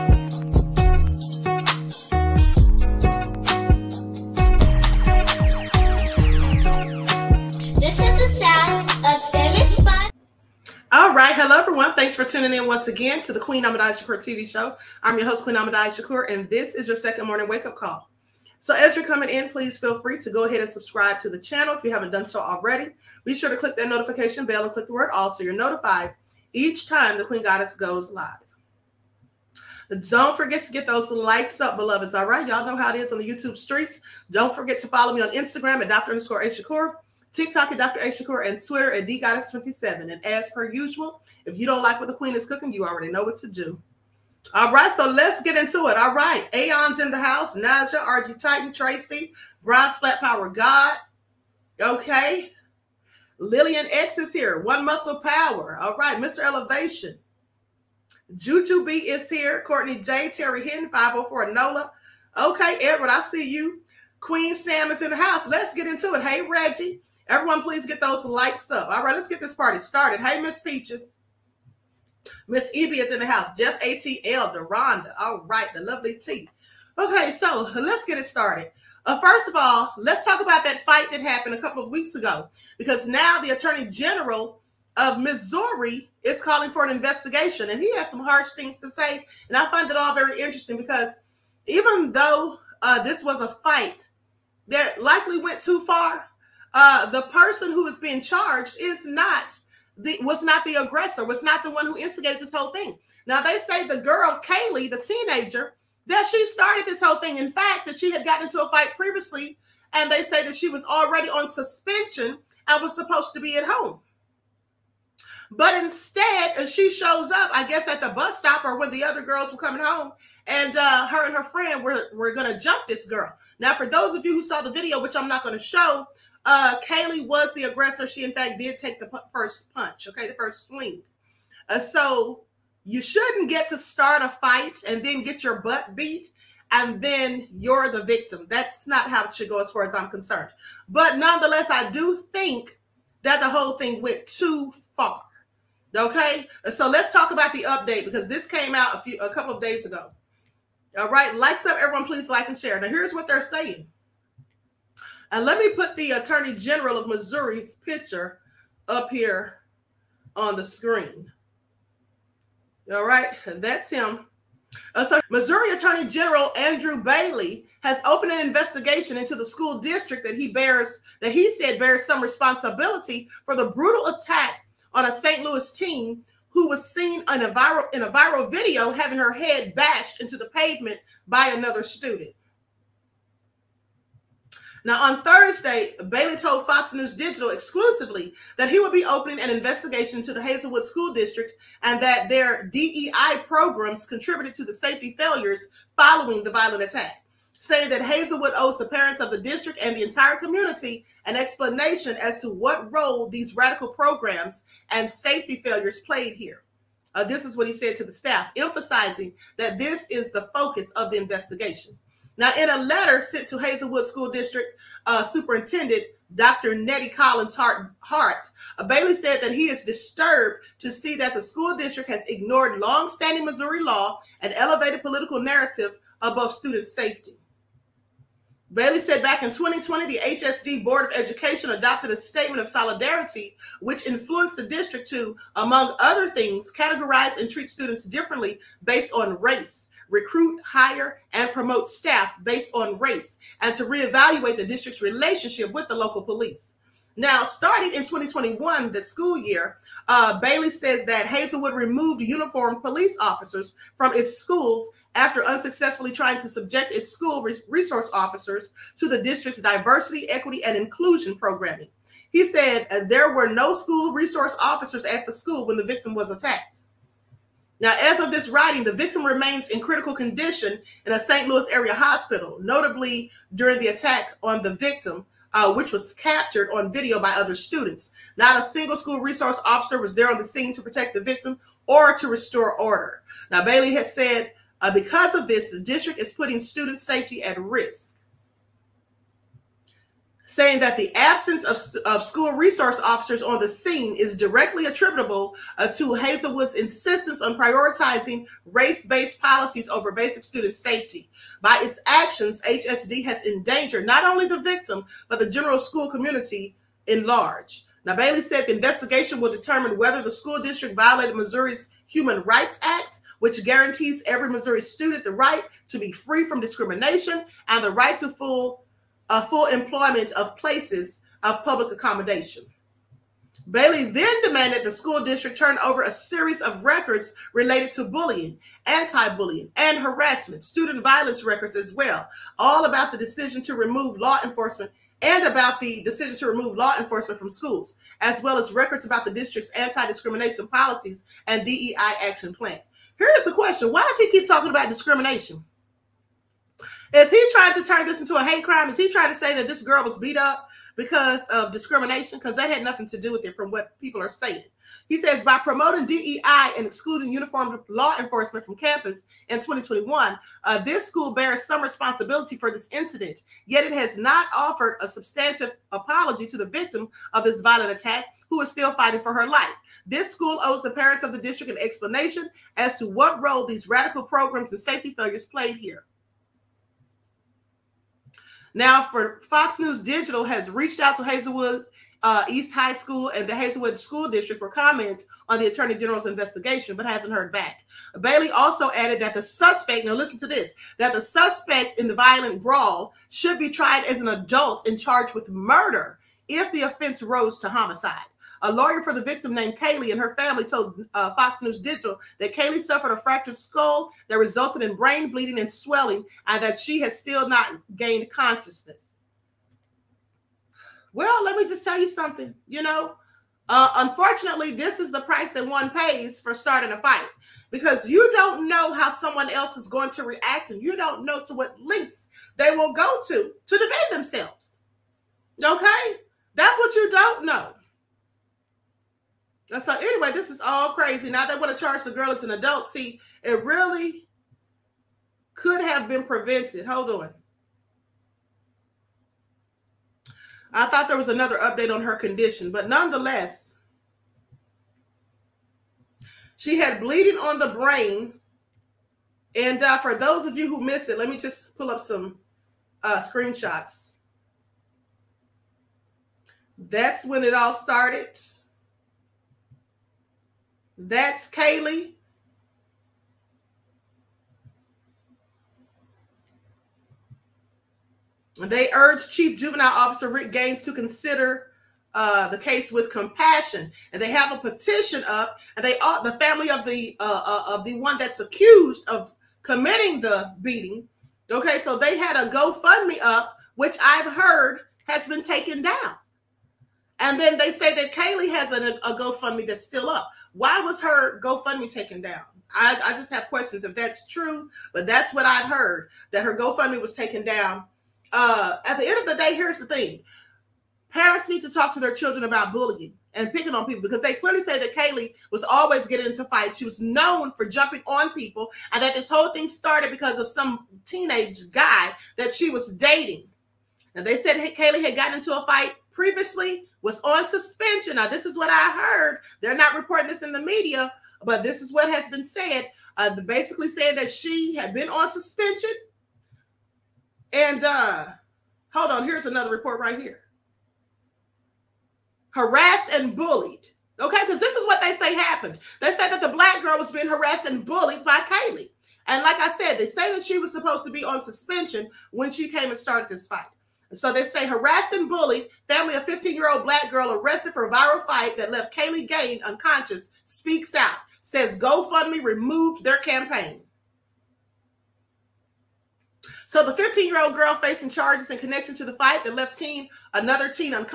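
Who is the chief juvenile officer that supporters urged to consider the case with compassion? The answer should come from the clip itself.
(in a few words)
Rick Gaines.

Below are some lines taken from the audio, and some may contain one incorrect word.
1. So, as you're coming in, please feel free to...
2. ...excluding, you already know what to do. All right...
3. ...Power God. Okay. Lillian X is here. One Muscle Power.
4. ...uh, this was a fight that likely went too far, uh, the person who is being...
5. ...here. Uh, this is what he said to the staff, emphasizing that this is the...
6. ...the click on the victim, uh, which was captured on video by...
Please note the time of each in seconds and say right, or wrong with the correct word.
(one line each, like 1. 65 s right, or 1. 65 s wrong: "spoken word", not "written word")
1. 18 s right
2. 42 s wrong: "cooking", not "excluding"
3. 50 s right
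4. 92 s right
5. 206 s right
6. 273 s wrong: "attack", not "click".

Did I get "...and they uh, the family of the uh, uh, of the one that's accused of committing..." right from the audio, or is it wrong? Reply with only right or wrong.
right.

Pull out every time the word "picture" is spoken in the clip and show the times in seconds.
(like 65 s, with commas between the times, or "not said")
157 s.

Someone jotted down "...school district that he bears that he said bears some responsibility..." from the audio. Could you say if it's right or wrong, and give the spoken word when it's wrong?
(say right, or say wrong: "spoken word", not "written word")
right.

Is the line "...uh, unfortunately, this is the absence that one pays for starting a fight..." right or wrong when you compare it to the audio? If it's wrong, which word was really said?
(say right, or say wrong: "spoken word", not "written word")
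wrong: "price", not "absence".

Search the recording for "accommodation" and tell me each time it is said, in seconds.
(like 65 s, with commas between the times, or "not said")
321 s.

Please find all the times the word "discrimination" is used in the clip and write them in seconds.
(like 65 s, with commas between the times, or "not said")
316 s, 340 s, 344 s, 351 s.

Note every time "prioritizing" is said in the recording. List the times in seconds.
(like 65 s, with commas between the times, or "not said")
297 s.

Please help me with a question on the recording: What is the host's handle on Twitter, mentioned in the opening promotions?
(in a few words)
DGoddess27.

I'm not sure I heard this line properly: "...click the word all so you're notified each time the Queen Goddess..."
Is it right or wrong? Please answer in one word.
right.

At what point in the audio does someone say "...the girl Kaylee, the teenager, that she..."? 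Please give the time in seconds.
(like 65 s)
103 s.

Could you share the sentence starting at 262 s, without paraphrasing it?
He said uh, there were no school resource officers at the school when the victim was attacked.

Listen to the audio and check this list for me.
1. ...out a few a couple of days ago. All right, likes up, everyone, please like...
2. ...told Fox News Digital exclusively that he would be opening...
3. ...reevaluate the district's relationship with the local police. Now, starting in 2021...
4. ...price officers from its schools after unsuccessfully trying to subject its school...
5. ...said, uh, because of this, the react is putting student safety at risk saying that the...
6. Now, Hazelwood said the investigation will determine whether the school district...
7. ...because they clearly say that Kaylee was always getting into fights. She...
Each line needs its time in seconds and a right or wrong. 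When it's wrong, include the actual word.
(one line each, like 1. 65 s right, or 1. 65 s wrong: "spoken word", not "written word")
1. 148 s right
2. 186 s right
3. 243 s right
4. 252 s wrong: "police", not "price"
5. 284 s wrong: "district", not "react"
6. 308 s wrong: "Bailey", not "Hazelwood"
7. 504 s right.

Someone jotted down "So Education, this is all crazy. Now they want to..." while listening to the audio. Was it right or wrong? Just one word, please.
wrong.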